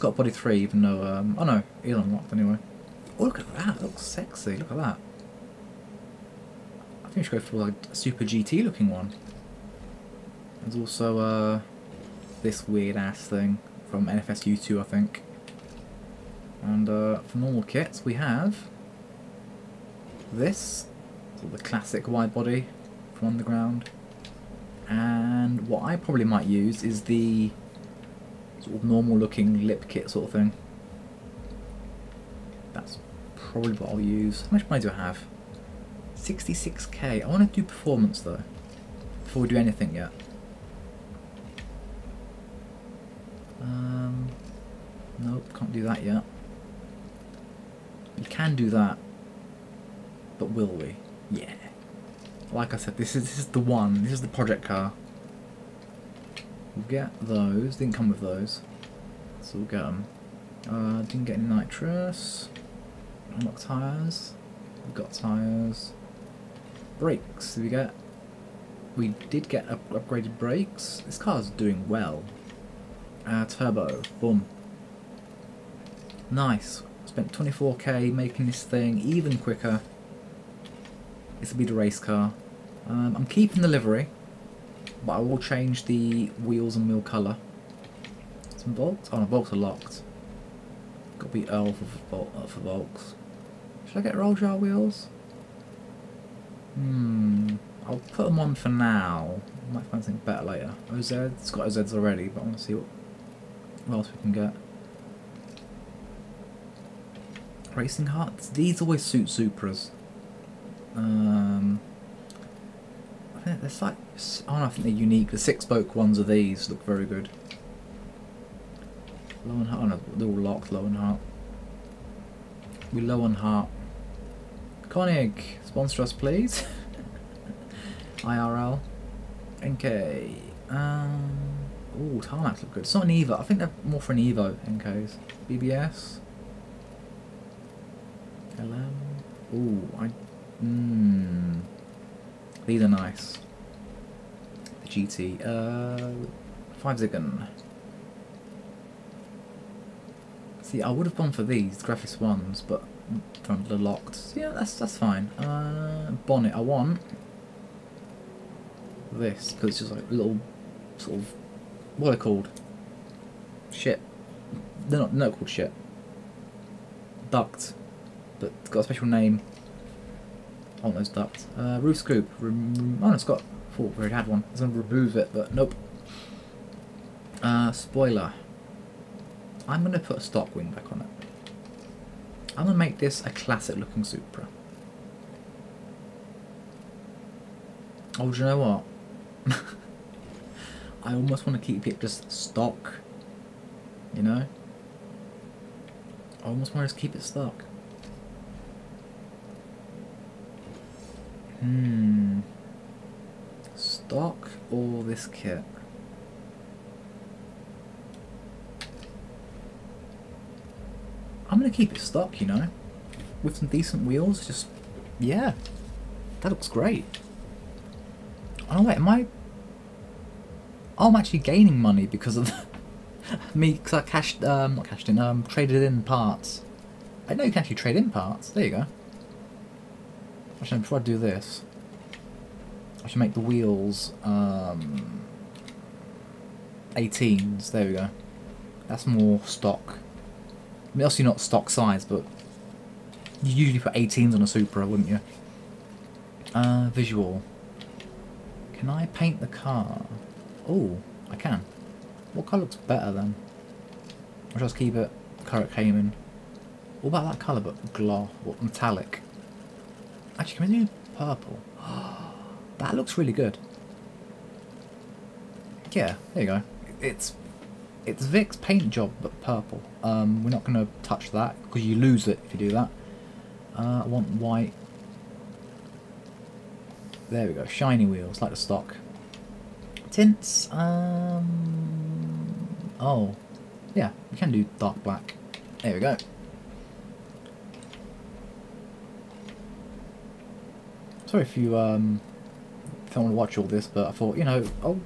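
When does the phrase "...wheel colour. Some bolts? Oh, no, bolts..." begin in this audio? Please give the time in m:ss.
1:26.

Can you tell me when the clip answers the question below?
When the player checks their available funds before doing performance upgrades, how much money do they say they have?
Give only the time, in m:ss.
0:36.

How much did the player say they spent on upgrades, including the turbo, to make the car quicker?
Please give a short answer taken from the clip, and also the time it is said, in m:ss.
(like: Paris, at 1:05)
24k, at 1:17.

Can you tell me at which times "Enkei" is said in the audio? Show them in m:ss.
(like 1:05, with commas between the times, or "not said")
2:09, 2:14.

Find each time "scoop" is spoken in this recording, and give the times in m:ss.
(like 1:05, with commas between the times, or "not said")
2:51.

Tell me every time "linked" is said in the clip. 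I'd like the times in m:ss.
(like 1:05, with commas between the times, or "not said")
not said.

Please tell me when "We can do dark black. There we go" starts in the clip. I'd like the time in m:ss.
4:44.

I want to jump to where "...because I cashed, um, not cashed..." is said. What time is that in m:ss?
3:43.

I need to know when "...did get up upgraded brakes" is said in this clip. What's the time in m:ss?
1:09.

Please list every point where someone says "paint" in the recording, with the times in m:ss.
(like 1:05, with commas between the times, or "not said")
4:09, 4:28.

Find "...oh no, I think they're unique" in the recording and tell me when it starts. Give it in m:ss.
1:54.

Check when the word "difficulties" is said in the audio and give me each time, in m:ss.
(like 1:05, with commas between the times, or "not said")
not said.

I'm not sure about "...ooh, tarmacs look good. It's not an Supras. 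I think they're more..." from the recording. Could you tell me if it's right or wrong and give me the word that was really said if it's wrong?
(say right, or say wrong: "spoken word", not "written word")
wrong: "Evo", not "Supras".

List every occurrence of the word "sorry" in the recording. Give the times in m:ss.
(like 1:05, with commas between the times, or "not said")
4:51.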